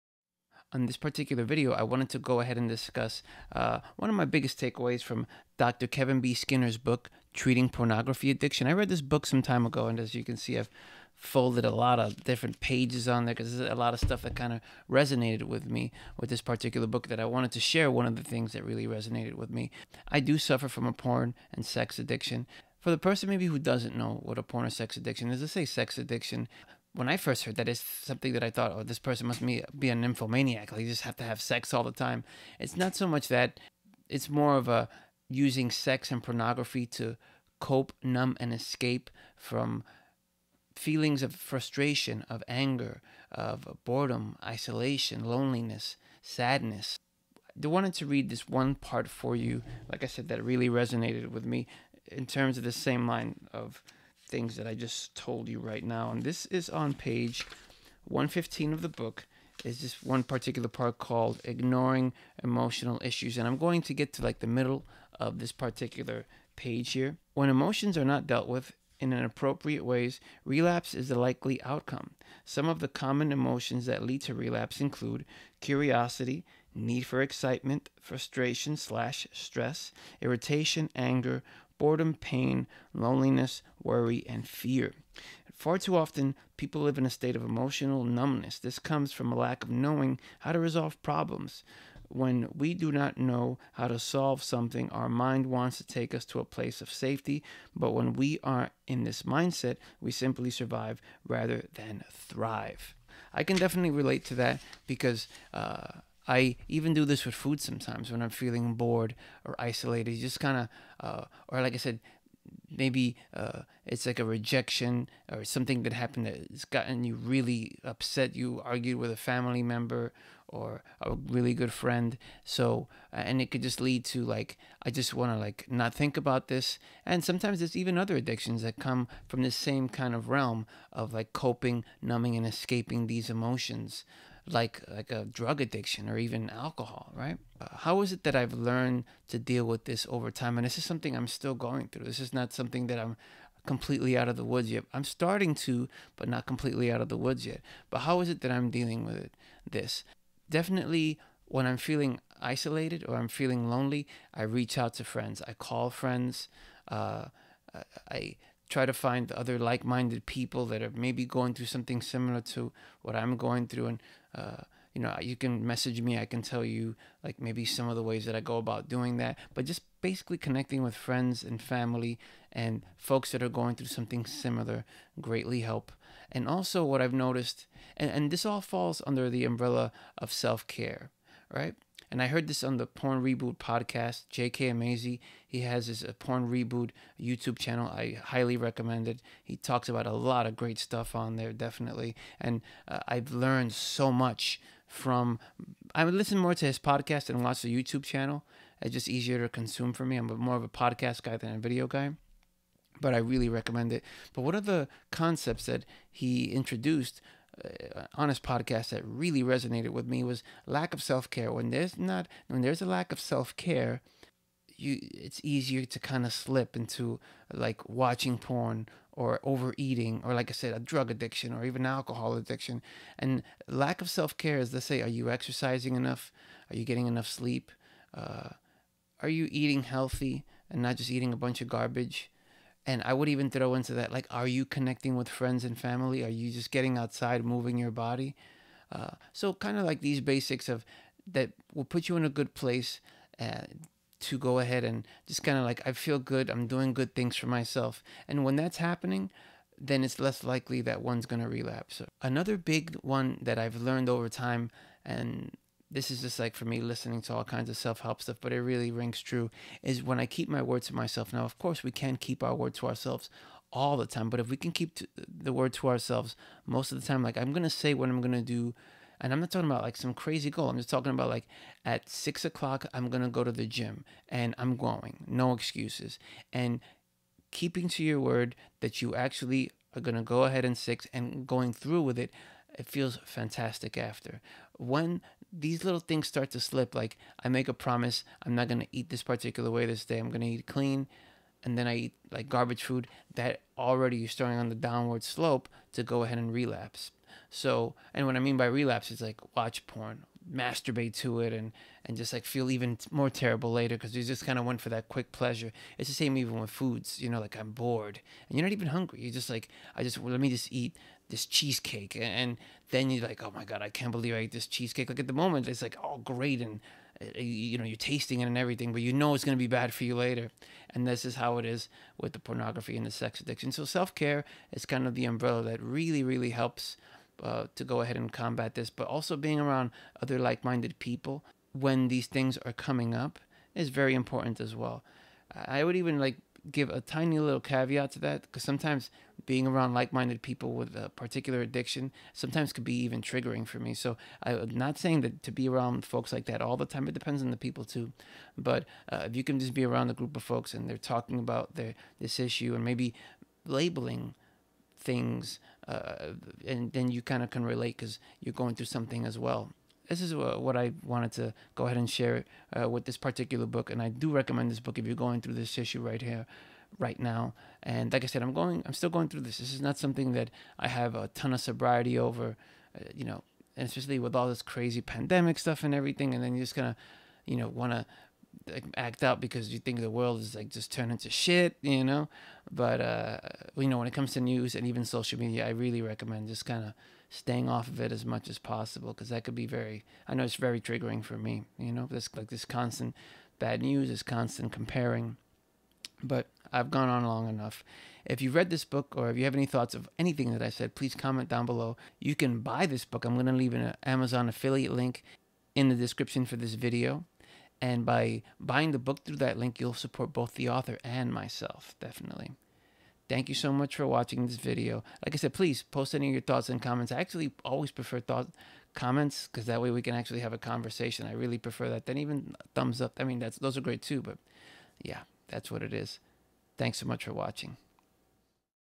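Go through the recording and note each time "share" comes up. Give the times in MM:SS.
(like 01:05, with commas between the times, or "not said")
00:17, 06:02.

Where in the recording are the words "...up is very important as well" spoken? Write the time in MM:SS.
05:33.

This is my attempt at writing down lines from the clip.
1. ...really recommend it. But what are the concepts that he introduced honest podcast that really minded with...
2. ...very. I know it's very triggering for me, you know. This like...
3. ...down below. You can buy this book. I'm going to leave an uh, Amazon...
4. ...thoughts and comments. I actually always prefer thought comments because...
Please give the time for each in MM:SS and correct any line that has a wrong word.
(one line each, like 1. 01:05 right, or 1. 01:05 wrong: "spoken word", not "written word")
1. 03:23 wrong: "resonated", not "minded"
2. 06:29 right
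3. 06:41 right
4. 06:56 right.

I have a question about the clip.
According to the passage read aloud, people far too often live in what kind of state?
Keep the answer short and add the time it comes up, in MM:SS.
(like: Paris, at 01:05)
emotional numbness, at 01:27.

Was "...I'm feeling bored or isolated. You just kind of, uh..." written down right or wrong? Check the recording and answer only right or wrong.
right.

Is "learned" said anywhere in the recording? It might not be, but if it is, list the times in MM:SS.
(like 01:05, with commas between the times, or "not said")
02:18, 03:13, 04:13.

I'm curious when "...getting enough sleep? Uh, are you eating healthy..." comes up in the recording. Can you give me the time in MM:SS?
03:46.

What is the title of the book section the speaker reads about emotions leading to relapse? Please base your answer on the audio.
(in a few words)
Ignoring Emotional Issues.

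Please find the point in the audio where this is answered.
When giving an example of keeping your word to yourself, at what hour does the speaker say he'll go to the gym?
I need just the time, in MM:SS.
04:32.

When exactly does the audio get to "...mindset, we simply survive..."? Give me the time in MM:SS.
01:39.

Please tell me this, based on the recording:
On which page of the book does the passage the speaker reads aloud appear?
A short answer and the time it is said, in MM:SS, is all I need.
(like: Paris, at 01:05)
115, at 00:56.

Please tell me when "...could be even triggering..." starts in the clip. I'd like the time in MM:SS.
05:42.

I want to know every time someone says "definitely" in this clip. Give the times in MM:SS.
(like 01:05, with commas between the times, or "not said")
01:43, 02:30, 03:11, 06:51.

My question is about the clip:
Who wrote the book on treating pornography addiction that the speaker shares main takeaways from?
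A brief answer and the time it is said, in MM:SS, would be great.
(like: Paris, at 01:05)
Kevin B. Skinner, at 00:05.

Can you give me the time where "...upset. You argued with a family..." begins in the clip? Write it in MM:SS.
01:57.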